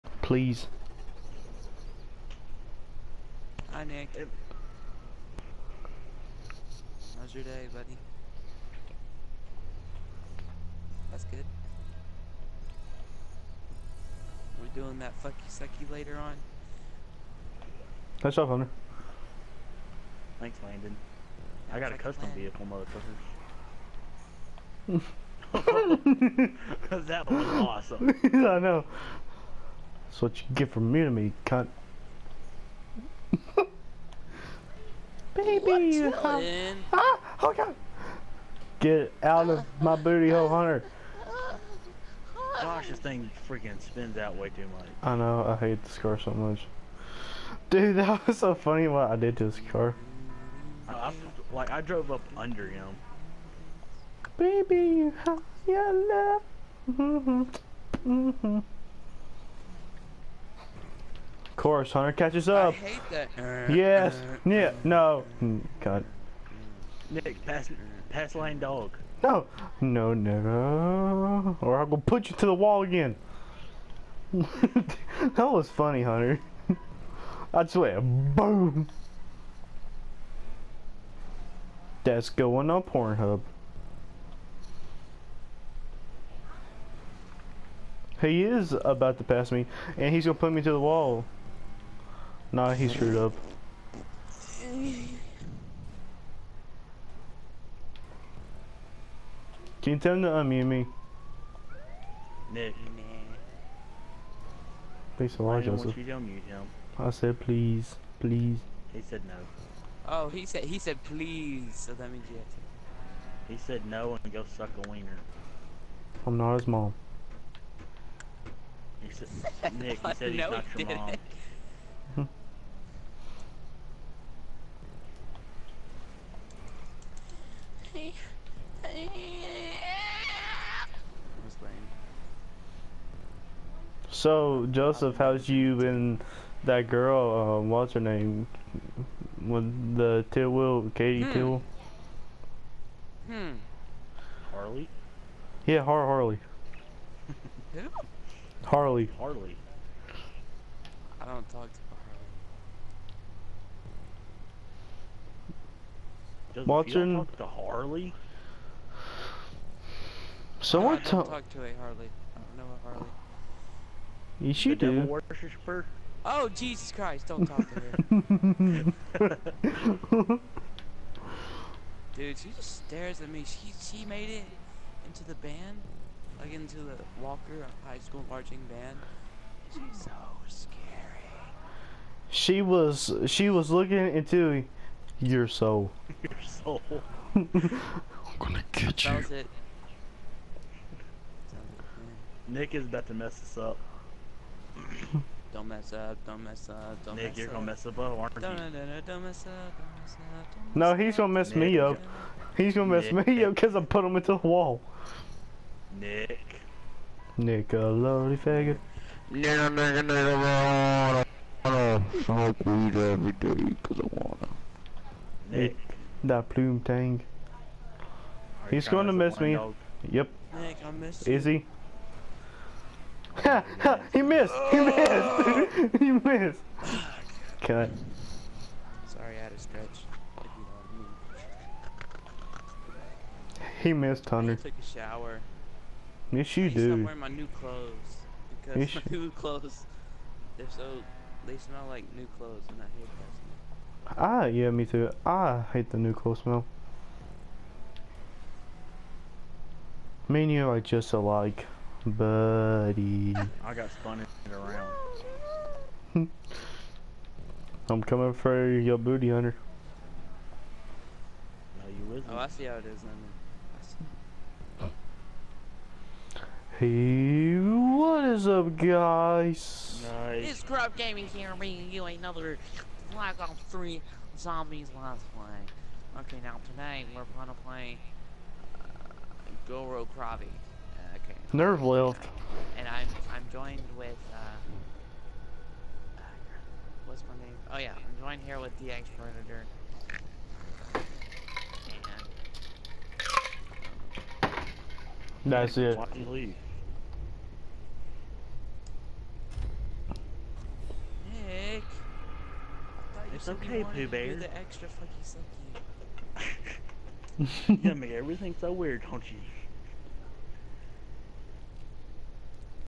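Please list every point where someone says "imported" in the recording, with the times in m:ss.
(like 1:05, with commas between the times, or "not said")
not said.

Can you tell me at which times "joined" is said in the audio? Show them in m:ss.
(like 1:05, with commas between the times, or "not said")
4:43, 4:48.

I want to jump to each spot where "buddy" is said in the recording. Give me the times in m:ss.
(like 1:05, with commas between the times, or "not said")
0:07, 4:12.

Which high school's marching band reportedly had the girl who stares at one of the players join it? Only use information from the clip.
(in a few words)
Walker High School.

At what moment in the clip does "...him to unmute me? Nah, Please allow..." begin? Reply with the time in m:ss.
1:40.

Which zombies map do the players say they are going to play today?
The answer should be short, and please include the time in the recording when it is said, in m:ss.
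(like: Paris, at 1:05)
Gorod Krovi, at 4:39.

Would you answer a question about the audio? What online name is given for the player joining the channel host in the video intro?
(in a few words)
DX Predator.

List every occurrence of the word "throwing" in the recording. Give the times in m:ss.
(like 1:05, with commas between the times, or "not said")
not said.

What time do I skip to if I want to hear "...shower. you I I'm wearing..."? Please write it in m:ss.
3:54.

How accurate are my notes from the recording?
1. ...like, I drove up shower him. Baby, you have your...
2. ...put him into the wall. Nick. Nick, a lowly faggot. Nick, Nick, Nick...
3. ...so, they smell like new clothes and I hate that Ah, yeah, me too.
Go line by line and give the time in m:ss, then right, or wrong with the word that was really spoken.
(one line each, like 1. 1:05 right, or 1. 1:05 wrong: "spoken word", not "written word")
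1. 0:51 wrong: "under", not "shower"
2. 3:23 right
3. 4:00 right.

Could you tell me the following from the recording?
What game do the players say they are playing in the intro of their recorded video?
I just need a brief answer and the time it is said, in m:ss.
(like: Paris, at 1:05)
Black Ops 3 Zombies, at 4:33.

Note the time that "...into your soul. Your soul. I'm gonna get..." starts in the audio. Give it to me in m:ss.
3:04.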